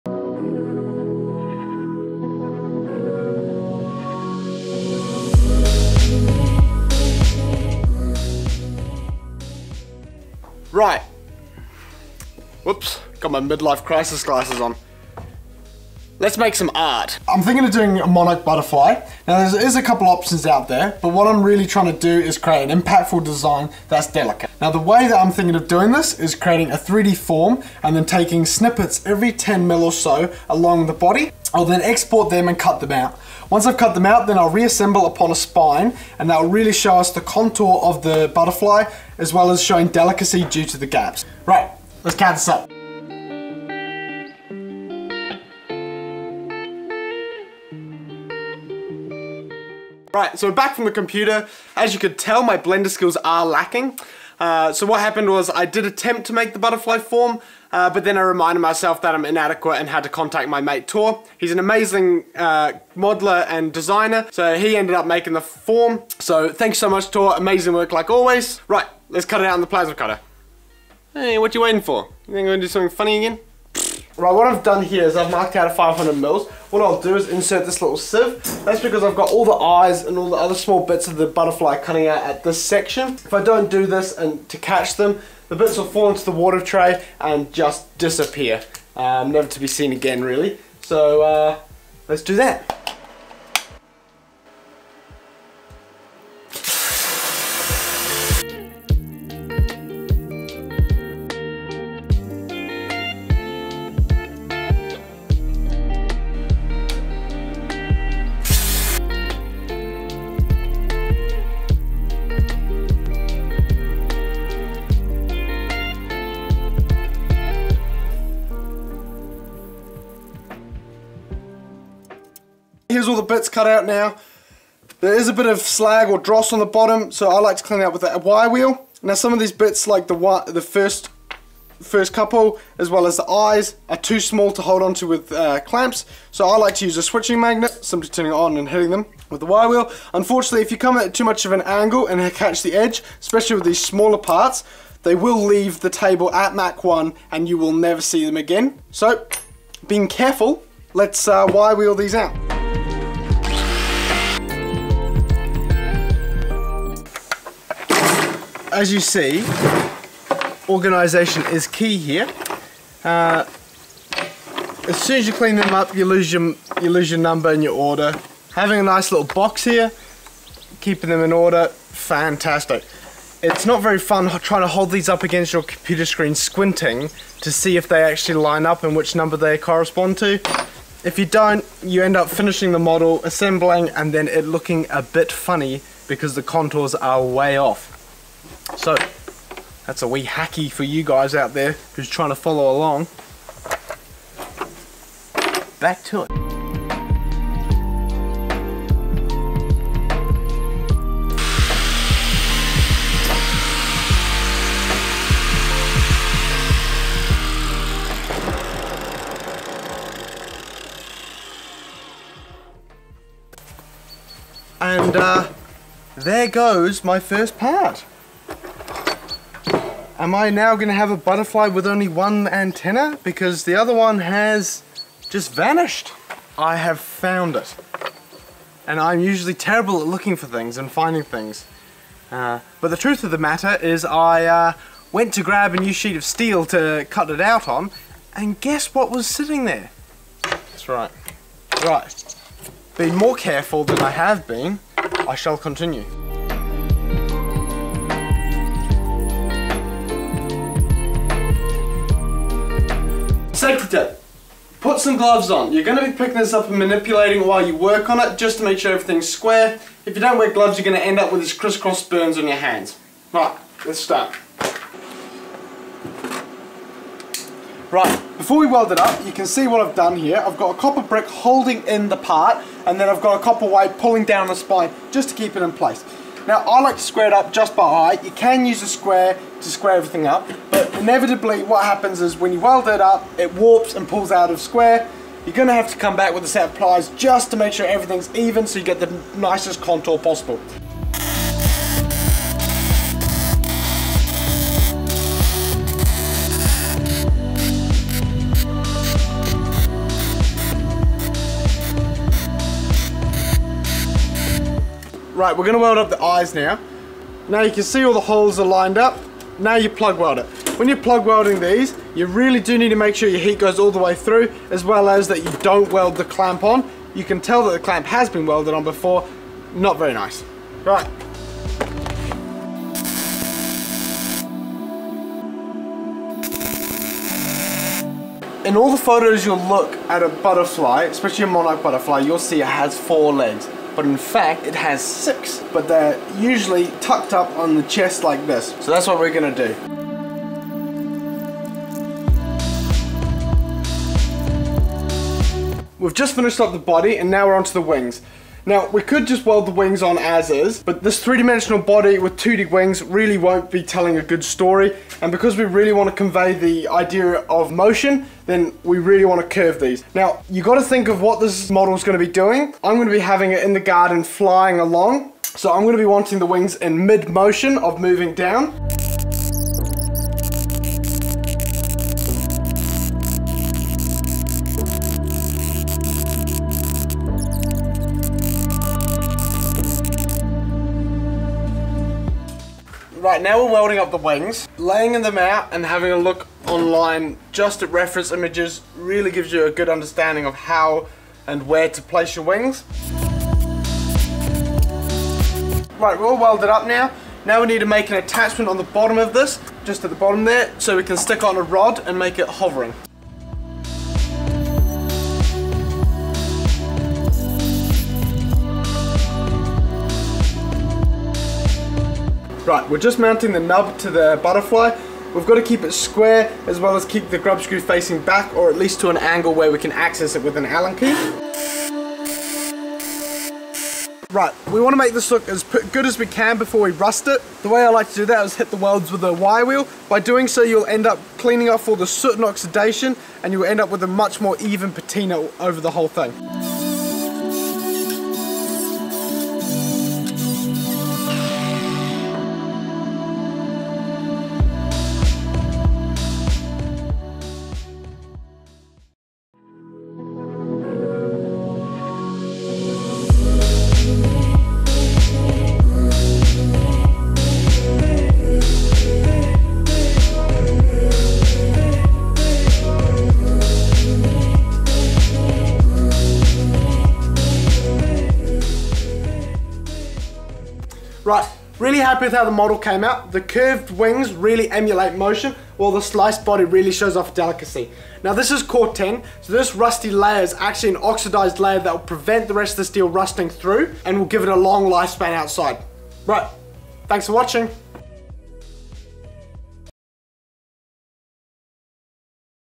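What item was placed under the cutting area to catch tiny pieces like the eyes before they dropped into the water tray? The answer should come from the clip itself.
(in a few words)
sieve.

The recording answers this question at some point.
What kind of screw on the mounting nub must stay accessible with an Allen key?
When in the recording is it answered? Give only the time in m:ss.
6:57.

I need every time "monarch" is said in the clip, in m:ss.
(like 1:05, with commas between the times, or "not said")
0:18, 5:31.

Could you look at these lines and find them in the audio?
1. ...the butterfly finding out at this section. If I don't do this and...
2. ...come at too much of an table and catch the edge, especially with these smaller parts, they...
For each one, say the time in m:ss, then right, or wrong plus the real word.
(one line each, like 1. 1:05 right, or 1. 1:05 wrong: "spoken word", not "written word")
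1. 1:21 wrong: "cutting", not "finding"
2. 2:20 wrong: "angle", not "table".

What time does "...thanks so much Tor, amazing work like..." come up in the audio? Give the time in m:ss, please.
1:06.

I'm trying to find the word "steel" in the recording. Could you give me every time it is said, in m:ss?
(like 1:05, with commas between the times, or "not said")
3:56, 8:02.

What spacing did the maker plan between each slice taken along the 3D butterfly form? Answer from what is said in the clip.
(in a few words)
10 mm.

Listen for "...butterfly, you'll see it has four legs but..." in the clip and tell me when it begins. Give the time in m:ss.
5:31.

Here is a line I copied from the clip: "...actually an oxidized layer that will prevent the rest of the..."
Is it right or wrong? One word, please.
right.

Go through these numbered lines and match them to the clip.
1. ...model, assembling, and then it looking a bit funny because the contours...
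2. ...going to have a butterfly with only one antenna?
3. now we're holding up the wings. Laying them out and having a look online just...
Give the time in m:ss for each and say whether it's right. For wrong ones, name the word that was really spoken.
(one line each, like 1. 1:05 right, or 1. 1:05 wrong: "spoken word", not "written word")
1. 3:02 right
2. 3:40 right
3. 6:23 wrong: "welding", not "holding".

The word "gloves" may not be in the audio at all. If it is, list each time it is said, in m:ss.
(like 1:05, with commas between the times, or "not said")
4:15, 4:20.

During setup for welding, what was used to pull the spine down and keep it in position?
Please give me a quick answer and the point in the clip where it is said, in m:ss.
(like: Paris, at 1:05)
copper wire, at 4:33.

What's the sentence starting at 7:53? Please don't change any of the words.
The curved wings really emulate motion, while the sliced body really shows off delicacy.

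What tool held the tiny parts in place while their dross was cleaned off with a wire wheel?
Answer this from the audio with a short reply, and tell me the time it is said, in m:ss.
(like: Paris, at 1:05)
switching magnet, at 2:17.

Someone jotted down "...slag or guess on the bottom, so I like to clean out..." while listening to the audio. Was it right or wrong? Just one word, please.
wrong.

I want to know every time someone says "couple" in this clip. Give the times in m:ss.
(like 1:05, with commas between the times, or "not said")
0:19, 2:12.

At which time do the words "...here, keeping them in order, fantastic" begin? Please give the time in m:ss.
2:49.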